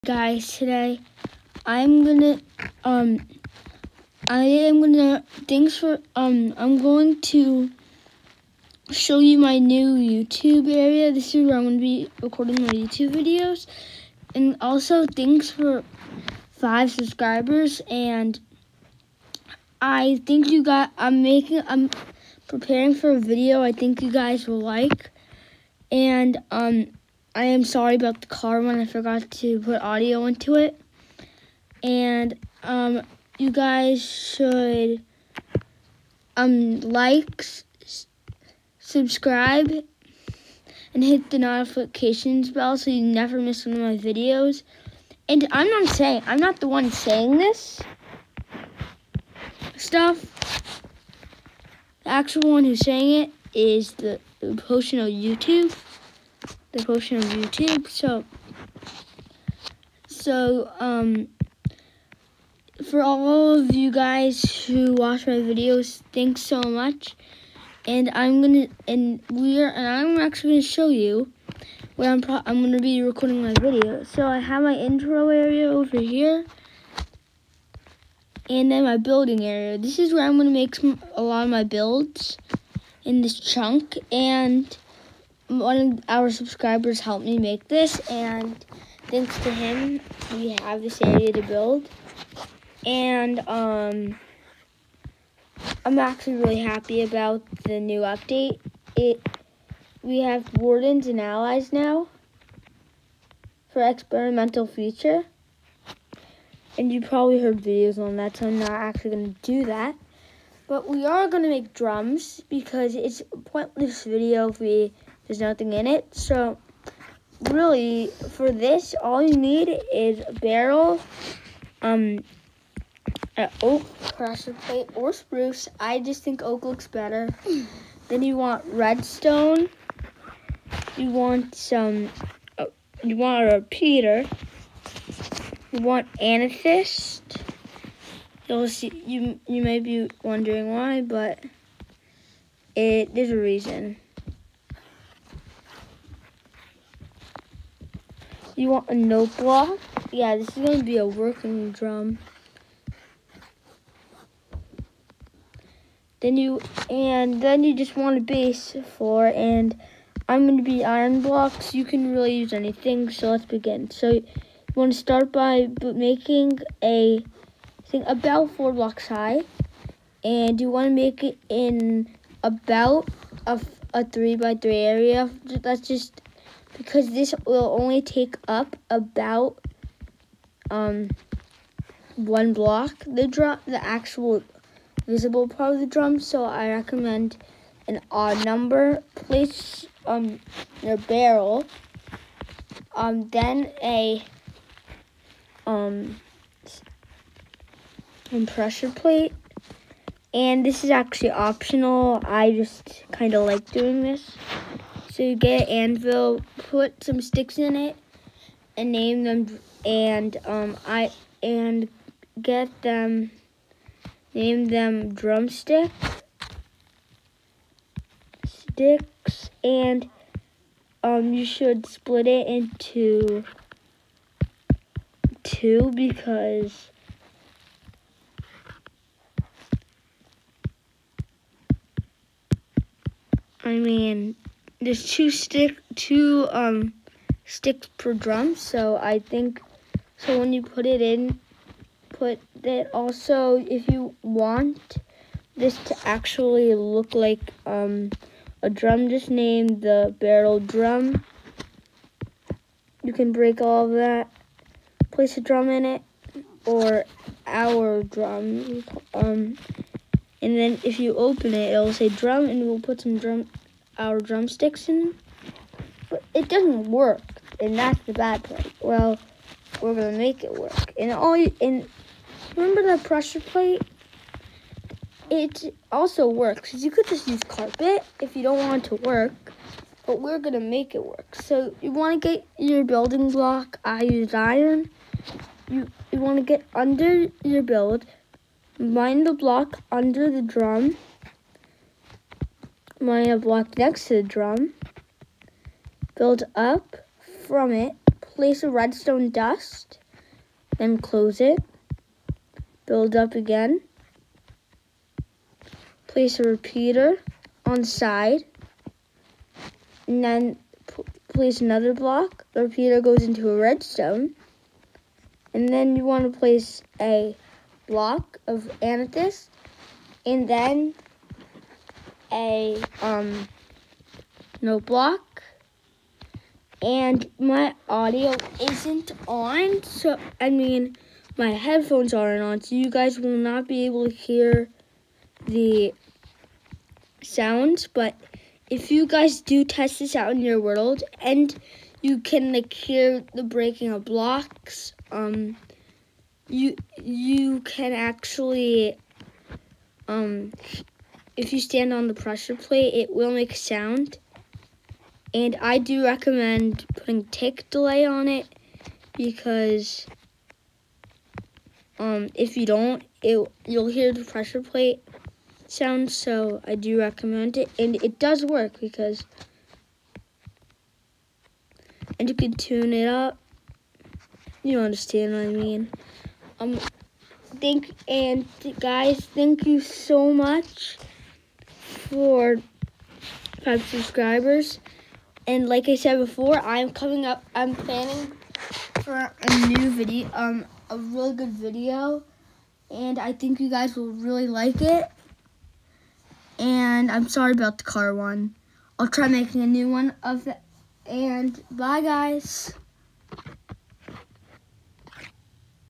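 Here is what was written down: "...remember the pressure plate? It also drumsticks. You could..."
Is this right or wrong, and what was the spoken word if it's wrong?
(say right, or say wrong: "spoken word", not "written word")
wrong: "works", not "drumsticks".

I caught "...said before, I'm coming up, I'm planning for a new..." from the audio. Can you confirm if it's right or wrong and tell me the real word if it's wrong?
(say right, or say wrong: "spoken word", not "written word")
right.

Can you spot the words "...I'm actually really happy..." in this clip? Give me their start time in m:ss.
1:35.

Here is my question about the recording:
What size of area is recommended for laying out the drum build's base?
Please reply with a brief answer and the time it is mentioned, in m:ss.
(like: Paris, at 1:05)
3 by 3, at 2:54.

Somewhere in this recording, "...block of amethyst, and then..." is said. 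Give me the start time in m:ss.
5:17.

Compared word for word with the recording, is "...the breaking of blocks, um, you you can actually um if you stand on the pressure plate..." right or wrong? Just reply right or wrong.
right.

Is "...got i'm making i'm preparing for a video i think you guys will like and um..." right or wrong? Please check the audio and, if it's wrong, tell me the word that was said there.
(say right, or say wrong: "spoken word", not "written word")
right.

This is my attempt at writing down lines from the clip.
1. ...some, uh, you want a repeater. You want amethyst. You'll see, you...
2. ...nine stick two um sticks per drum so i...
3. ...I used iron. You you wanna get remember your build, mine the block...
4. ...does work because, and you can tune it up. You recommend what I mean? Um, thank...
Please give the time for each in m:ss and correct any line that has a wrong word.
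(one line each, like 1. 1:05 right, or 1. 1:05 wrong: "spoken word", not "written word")
1. 2:11 right
2. 3:55 wrong: "two", not "nine"
3. 4:43 wrong: "under", not "remember"
4. 6:08 wrong: "understand", not "recommend".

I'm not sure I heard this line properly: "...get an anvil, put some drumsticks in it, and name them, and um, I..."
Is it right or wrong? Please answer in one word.
wrong.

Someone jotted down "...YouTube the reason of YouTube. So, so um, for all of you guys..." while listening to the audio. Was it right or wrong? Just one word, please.
wrong.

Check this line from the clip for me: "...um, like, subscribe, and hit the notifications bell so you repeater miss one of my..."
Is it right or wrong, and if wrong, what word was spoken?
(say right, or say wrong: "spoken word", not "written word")
wrong: "never", not "repeater".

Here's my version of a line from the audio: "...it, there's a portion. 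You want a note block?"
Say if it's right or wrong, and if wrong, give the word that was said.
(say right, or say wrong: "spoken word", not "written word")
wrong: "reason", not "portion".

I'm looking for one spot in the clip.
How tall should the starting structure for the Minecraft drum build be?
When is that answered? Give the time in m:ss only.
2:48.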